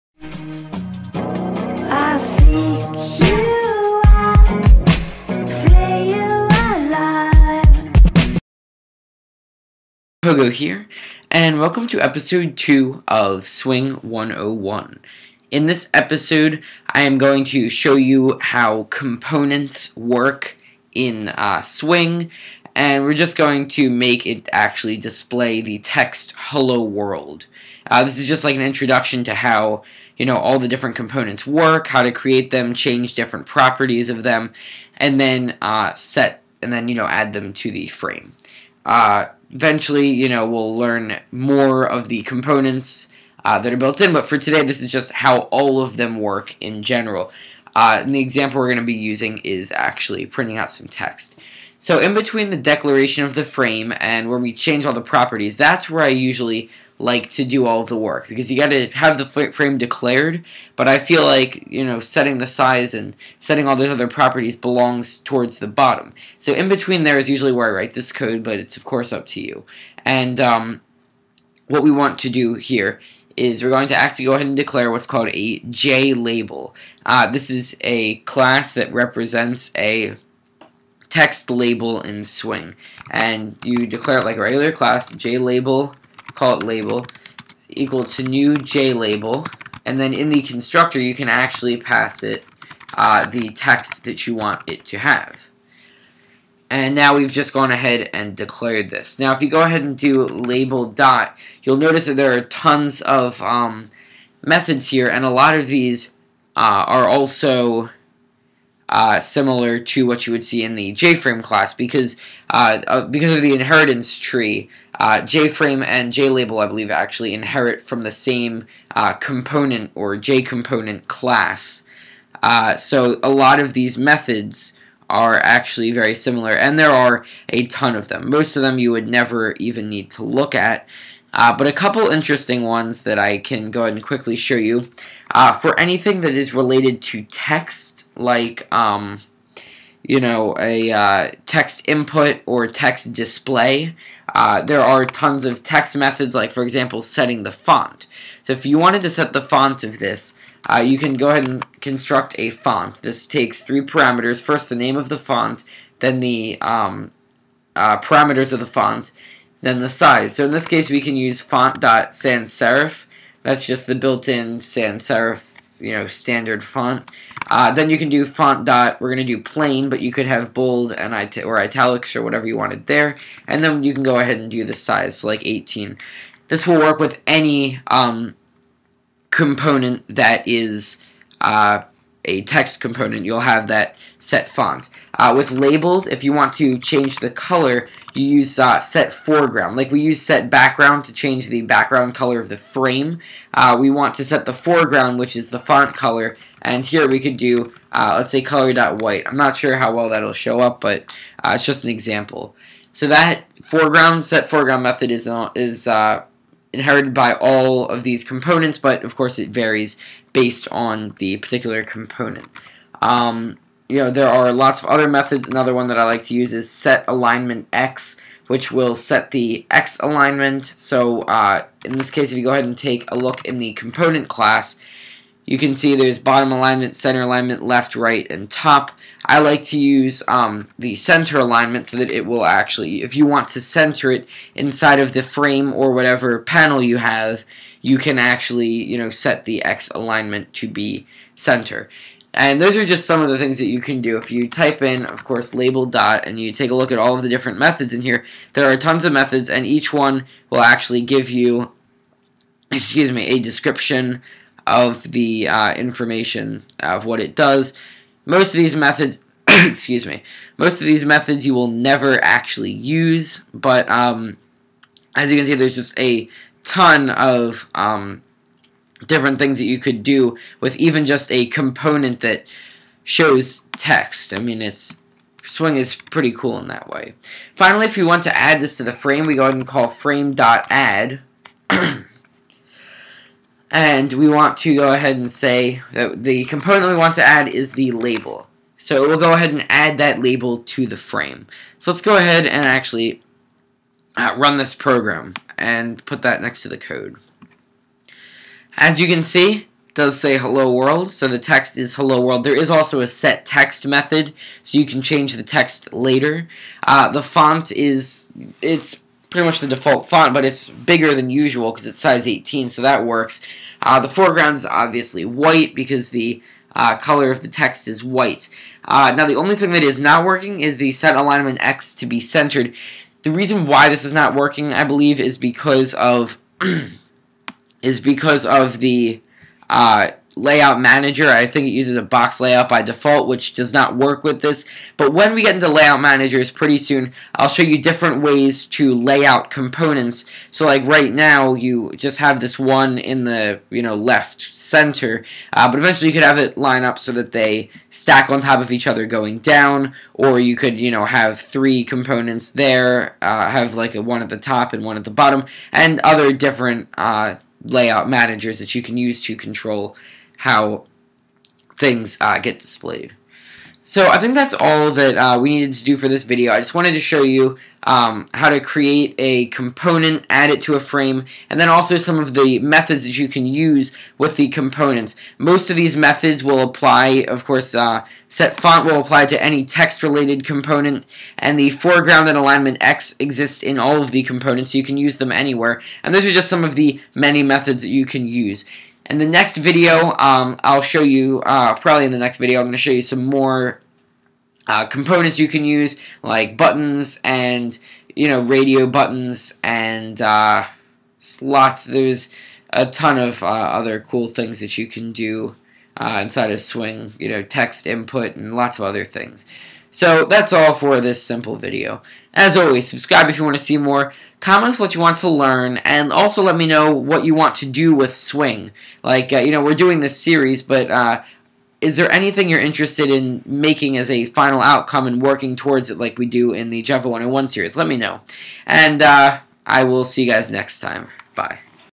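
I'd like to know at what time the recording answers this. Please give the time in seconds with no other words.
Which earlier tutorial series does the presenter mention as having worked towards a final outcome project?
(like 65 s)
426 s.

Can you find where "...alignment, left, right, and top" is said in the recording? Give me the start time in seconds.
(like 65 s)
227 s.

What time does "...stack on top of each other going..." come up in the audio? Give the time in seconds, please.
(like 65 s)
347 s.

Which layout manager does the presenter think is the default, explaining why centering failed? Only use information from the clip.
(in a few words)
box layout.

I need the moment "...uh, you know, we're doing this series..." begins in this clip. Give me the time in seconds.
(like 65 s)
419 s.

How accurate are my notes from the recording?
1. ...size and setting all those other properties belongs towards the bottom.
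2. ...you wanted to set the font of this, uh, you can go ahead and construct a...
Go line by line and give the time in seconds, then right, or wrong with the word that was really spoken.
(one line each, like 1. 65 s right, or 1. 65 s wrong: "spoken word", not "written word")
1. 62 s right
2. 148 s right.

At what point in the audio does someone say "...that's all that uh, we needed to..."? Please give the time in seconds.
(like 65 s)
364 s.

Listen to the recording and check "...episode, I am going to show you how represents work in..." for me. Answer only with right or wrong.
wrong.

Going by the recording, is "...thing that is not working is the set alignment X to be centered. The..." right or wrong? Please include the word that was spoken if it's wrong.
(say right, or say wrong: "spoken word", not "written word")
right.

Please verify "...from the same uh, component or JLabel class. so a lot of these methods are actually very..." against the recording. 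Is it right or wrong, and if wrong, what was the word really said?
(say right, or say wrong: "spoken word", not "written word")
wrong: "JComponent", not "JLabel".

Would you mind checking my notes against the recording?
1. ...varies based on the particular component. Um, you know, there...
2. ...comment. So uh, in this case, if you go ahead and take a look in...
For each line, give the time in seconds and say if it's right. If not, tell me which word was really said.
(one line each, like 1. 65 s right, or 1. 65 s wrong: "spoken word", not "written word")
1. 209 s right
2. 219 s wrong: "alignment", not "comment".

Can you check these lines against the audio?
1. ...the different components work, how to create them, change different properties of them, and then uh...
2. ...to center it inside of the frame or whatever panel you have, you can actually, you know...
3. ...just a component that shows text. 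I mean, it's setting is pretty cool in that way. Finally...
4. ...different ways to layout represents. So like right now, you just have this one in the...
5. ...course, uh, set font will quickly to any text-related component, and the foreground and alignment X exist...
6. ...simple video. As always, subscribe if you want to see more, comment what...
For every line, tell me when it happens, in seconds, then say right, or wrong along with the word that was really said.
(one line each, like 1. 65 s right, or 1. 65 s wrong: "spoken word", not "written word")
1. 30 s right
2. 233 s right
3. 271 s wrong: "swing", not "setting"
4. 337 s wrong: "components", not "represents"
5. 377 s wrong: "apply", not "quickly"
6. 411 s right.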